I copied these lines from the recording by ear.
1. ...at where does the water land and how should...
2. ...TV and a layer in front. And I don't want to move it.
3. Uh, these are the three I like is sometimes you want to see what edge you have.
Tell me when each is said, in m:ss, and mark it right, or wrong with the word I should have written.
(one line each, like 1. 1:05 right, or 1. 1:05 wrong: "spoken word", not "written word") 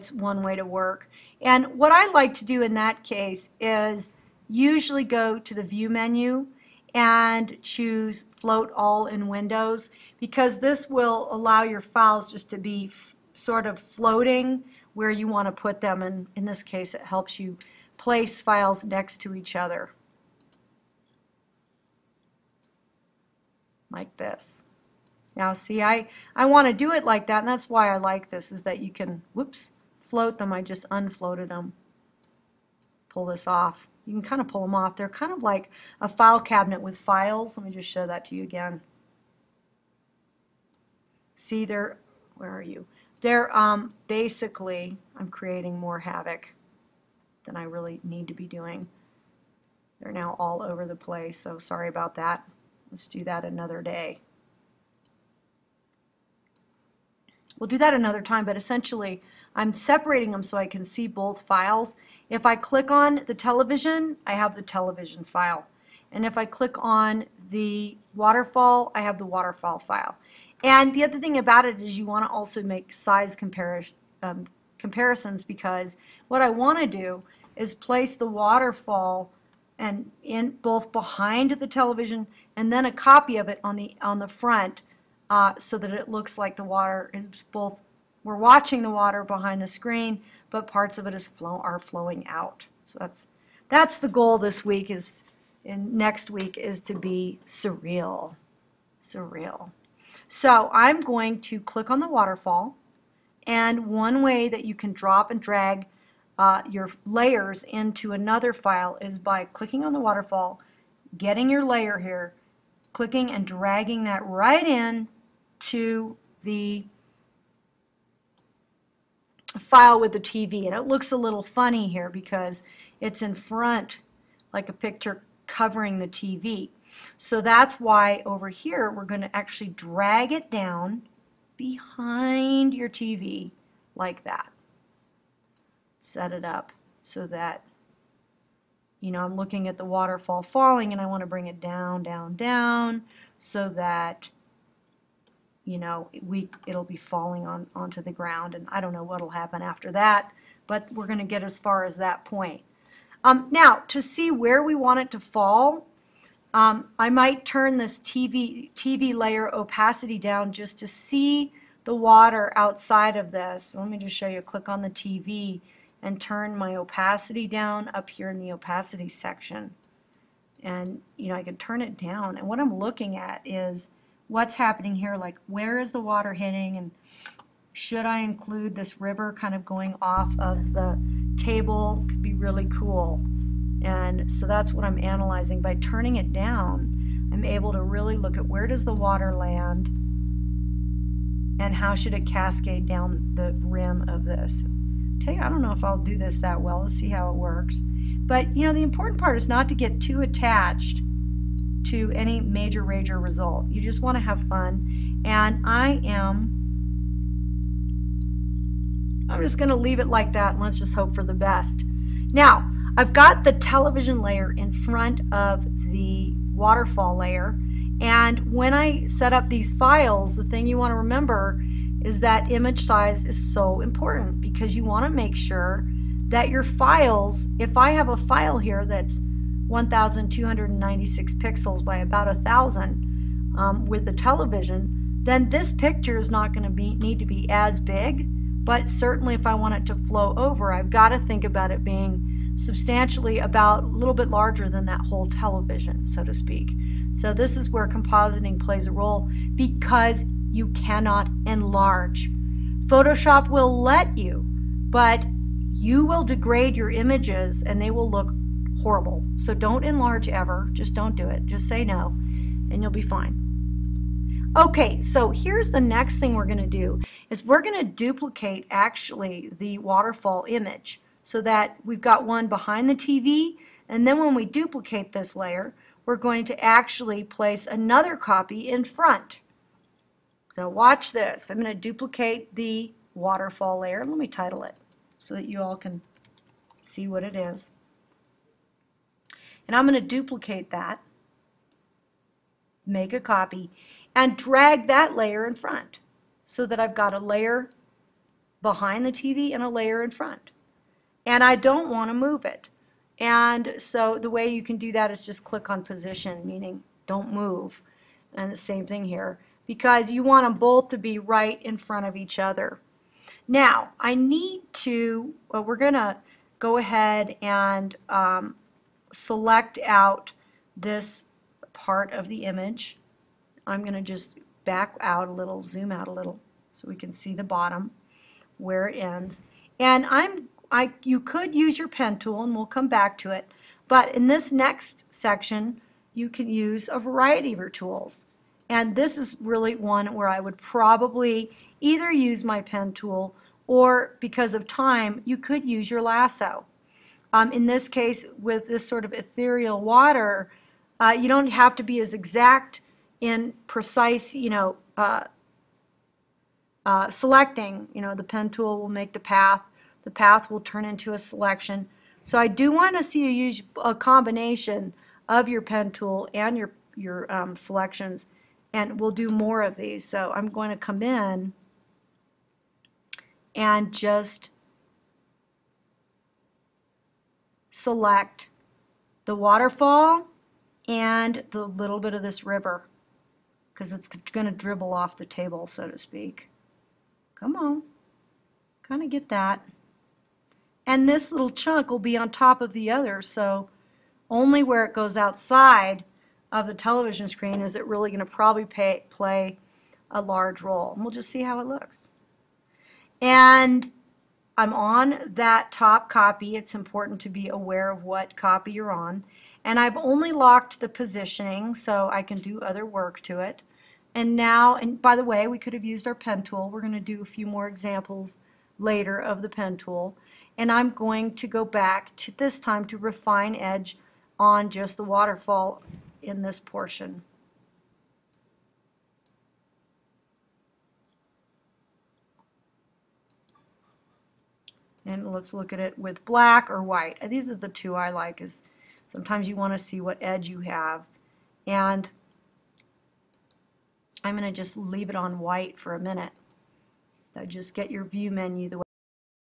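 1. 3:08 right
2. 4:59 right
3. 7:17 wrong: "two", not "three".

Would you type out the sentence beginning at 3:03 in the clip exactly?
And so that's what I'm analyzing.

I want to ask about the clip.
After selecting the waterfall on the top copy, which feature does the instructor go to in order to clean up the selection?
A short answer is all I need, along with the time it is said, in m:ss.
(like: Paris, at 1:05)
Refine Edge, at 7:02.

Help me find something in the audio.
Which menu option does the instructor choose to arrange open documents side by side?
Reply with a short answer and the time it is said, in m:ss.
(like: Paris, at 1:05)
Float All in Windows, at 0:08.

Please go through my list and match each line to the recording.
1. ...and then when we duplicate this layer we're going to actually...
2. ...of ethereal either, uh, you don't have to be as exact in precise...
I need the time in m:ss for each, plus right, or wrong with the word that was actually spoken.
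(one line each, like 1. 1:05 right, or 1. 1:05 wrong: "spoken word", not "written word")
1. 4:33 right
2. 5:49 wrong: "water", not "either".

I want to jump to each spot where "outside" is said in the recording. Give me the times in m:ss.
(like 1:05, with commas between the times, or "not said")
2:42, 6:35.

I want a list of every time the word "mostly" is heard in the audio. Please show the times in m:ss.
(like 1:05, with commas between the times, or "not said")
not said.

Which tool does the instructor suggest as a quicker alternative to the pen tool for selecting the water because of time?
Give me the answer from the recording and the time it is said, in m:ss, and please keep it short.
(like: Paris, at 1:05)
Lasso, at 5:46.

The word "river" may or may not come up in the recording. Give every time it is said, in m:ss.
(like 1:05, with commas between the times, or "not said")
2:58, 6:22.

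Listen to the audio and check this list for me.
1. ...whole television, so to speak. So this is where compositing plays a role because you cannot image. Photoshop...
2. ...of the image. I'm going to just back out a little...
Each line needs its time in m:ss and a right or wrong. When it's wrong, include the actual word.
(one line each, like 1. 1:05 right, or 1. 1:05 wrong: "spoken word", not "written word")
1. 4:05 wrong: "enlarge", not "image"
2. 5:22 right.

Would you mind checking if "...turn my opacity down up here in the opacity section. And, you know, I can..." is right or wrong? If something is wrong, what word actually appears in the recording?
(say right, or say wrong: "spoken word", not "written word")
right.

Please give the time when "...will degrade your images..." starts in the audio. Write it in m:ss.
4:16.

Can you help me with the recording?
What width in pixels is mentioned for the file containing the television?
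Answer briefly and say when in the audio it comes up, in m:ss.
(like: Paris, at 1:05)
1,296, at 3:49.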